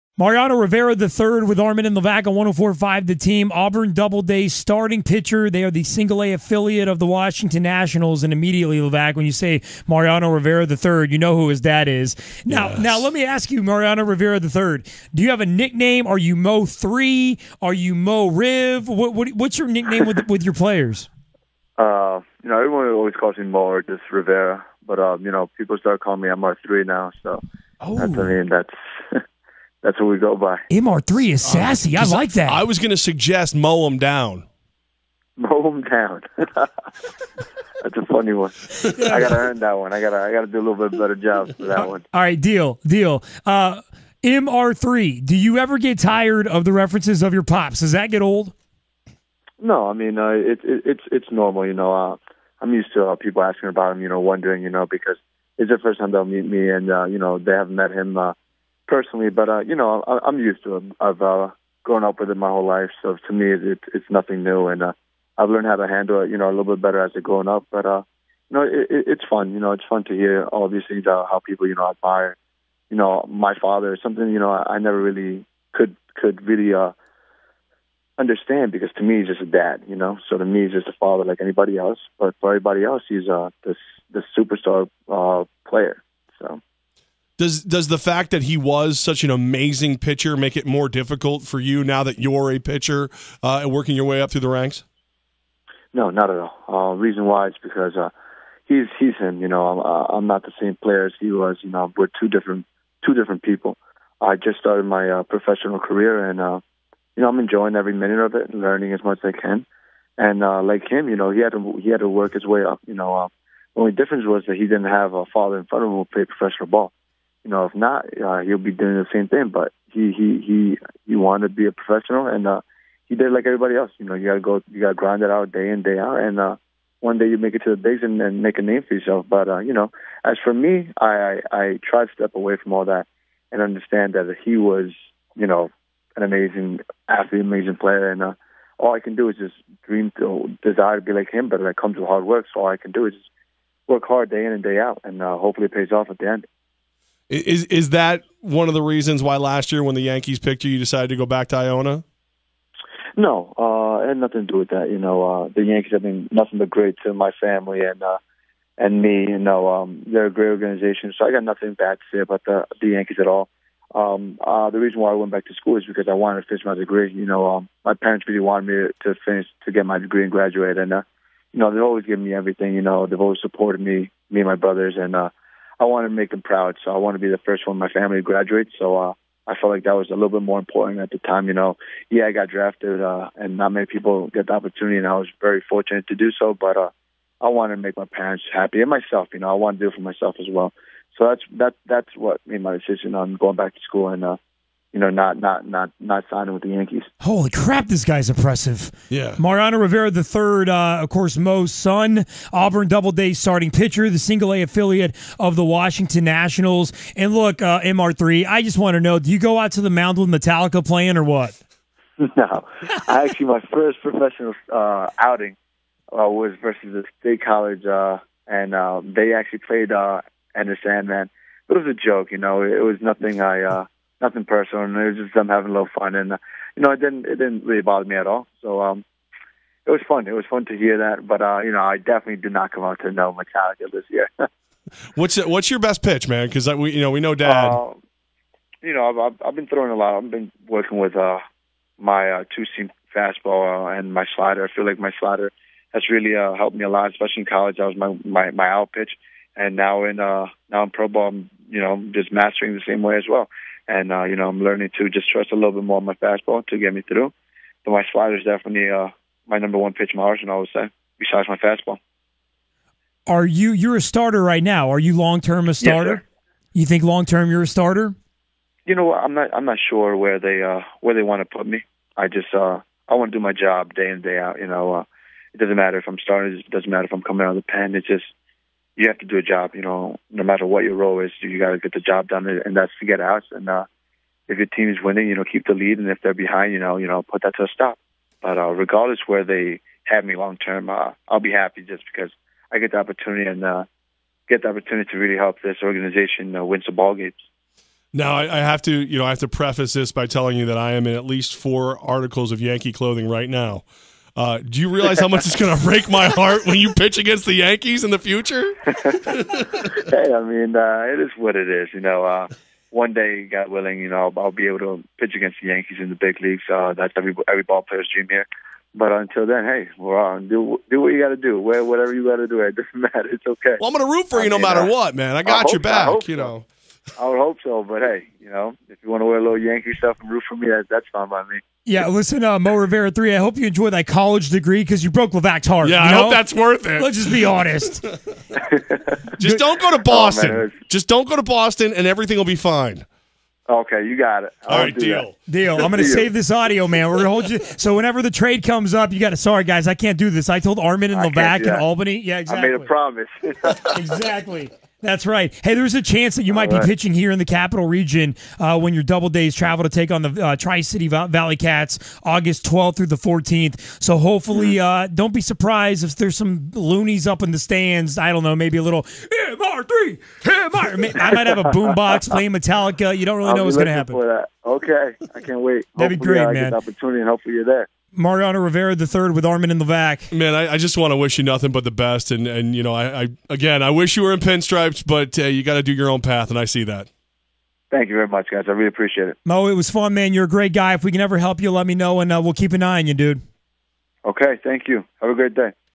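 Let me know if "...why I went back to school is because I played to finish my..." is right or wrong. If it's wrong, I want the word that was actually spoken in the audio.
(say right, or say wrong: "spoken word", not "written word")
wrong: "wanted", not "played".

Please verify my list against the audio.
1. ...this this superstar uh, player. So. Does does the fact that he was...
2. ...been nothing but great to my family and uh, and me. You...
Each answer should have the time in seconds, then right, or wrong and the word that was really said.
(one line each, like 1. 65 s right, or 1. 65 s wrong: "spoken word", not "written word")
1. 83 s right
2. 156 s right.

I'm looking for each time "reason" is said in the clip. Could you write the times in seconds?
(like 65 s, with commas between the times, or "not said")
96 s, 148 s, 164 s.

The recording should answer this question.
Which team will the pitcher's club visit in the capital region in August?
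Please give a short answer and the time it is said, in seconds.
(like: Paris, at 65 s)
Tri City ValleyCats, at 360 s.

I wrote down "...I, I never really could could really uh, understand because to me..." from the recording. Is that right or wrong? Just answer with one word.
right.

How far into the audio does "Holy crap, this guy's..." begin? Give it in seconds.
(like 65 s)
197 s.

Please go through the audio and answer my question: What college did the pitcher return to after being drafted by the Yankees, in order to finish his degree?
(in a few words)
Iona.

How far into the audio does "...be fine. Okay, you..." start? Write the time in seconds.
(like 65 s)
342 s.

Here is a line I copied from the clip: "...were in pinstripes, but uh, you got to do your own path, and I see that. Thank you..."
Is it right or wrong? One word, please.
right.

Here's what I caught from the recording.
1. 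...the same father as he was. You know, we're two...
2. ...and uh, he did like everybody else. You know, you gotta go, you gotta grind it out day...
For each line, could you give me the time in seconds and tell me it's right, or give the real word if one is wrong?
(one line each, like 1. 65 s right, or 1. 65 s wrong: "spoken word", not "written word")
1. 100 s wrong: "player", not "father"
2. 122 s right.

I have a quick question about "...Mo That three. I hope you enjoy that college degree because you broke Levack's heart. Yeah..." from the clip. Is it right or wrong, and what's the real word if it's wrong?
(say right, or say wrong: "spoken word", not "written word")
wrong: "Rivera", not "That".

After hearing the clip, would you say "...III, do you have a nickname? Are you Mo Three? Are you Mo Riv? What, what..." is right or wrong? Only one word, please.
right.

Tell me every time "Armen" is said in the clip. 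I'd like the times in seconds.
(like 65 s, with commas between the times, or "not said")
1 s, 350 s, 379 s.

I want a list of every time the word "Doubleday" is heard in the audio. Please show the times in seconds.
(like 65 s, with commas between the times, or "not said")
3 s, 359 s.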